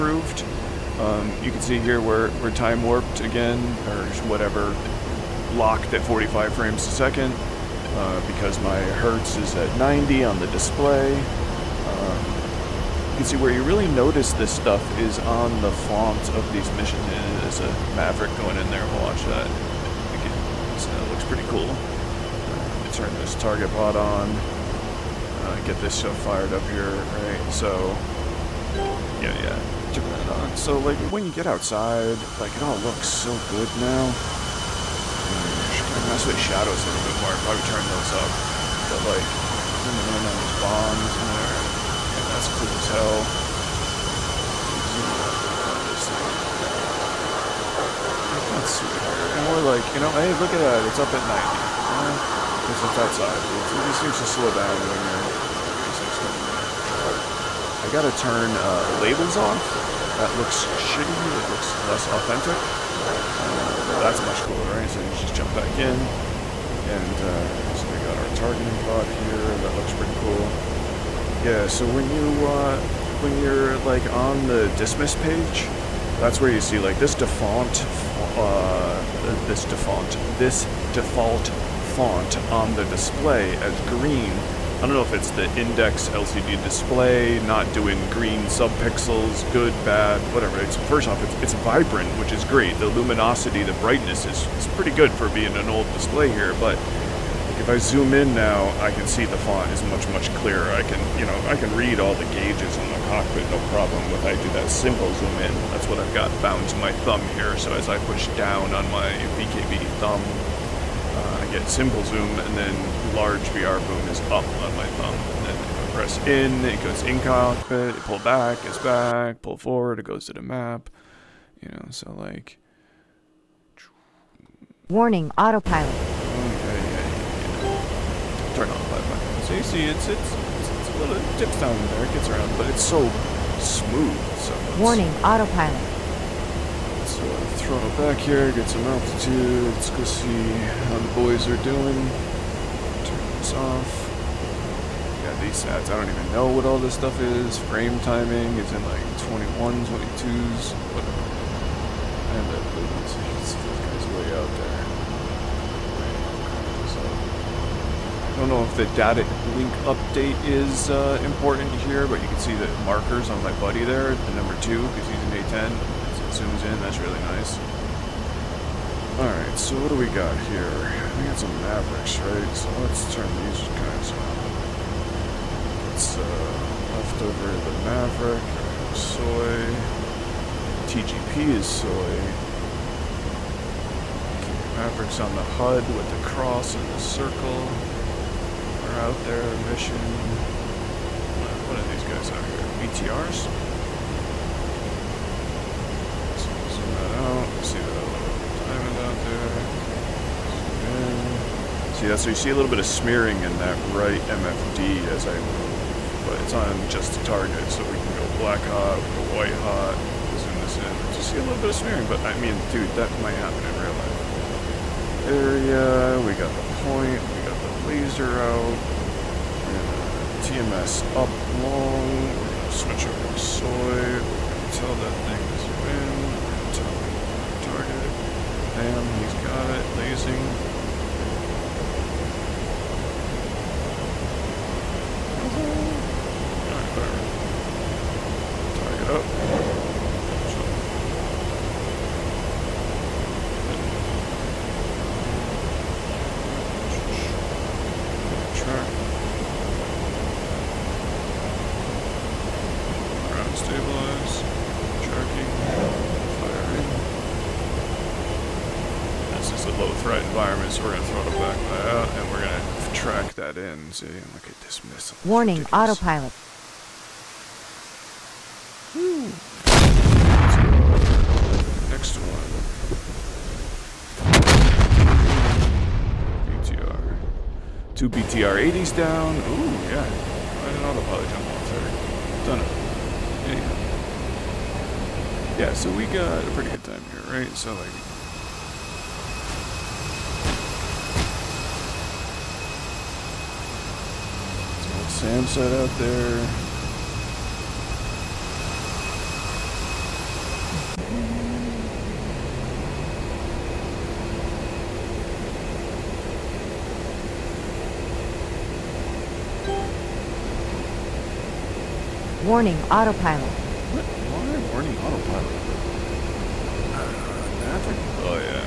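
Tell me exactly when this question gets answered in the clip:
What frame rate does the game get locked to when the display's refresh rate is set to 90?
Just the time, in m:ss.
0:06.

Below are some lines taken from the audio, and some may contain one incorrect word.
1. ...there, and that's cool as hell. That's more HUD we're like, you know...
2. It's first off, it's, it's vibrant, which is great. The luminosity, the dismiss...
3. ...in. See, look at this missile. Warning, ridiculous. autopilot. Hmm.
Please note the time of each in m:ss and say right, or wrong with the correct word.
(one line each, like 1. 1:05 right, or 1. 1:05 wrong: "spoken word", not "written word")
1. 0:41 wrong: "And", not "HUD"
2. 1:30 wrong: "brightness", not "dismiss"
3. 4:23 right.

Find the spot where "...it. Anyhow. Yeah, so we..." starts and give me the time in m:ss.
4:43.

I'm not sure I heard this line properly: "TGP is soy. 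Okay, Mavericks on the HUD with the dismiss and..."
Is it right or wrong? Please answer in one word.
wrong.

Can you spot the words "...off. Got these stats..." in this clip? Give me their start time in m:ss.
2:23.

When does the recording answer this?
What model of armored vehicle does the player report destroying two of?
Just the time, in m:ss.
4:38.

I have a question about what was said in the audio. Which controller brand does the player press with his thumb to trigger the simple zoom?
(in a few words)
VKB.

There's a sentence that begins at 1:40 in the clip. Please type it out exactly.
I can, you know, I can read all the gauges in the cockpit, no problem.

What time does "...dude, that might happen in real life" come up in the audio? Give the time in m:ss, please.
3:32.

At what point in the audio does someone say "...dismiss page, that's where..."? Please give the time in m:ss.
1:14.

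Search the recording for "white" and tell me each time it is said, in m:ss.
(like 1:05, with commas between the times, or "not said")
3:29.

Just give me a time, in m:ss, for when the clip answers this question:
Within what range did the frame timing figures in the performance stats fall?
2:29.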